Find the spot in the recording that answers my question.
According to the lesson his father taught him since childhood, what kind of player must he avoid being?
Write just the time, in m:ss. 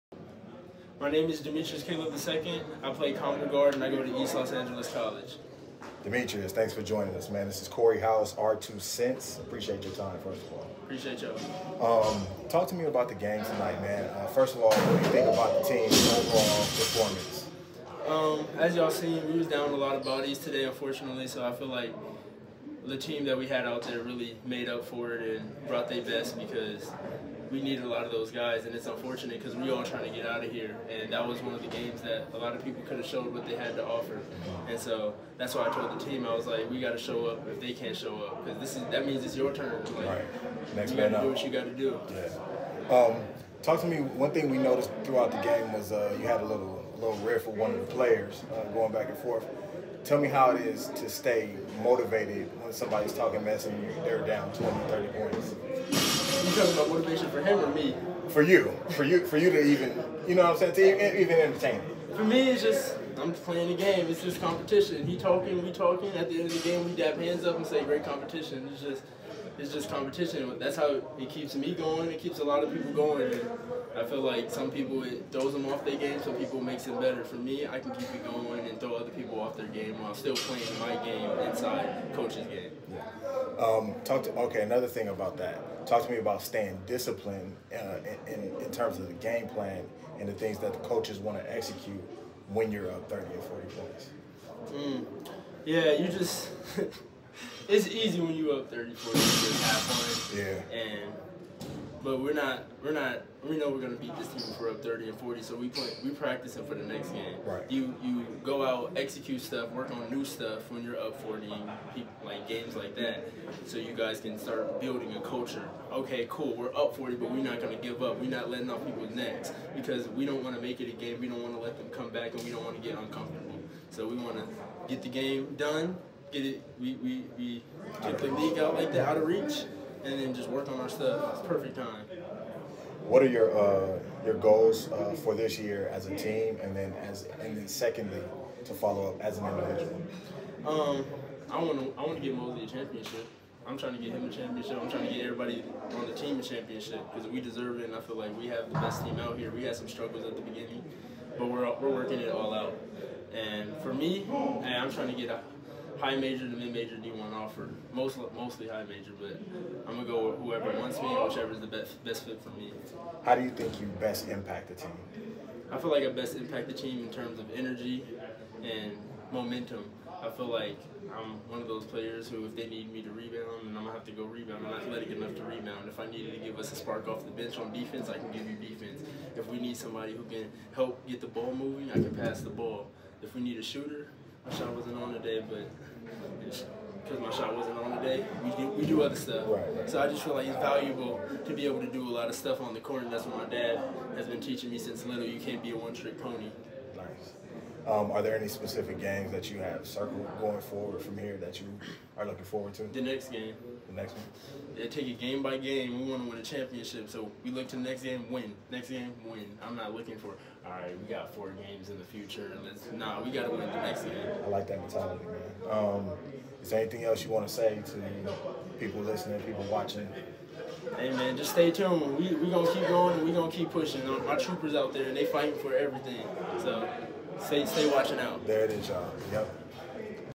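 3:15.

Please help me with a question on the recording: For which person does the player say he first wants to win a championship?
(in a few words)
Mosley.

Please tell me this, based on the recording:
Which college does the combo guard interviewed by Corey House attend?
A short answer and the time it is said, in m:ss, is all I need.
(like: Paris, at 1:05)
East Los Angeles College, at 0:04.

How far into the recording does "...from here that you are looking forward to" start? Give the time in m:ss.
3:21.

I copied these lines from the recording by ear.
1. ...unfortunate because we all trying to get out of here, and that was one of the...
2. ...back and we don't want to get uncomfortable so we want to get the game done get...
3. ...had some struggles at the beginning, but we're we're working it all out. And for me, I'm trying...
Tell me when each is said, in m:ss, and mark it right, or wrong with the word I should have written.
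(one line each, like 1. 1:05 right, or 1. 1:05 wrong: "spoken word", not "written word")
1. 0:28 right
2. 2:02 right
3. 2:29 right.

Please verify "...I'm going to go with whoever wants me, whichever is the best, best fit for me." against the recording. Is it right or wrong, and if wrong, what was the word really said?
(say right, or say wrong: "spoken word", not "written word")
right.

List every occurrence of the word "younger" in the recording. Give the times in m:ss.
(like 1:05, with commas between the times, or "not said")
not said.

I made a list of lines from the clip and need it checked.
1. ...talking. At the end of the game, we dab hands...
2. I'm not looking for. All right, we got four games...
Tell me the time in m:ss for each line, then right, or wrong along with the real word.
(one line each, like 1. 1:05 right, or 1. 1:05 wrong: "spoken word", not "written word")
1. 1:05 right
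2. 3:29 right.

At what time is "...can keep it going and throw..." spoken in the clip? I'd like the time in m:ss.
1:17.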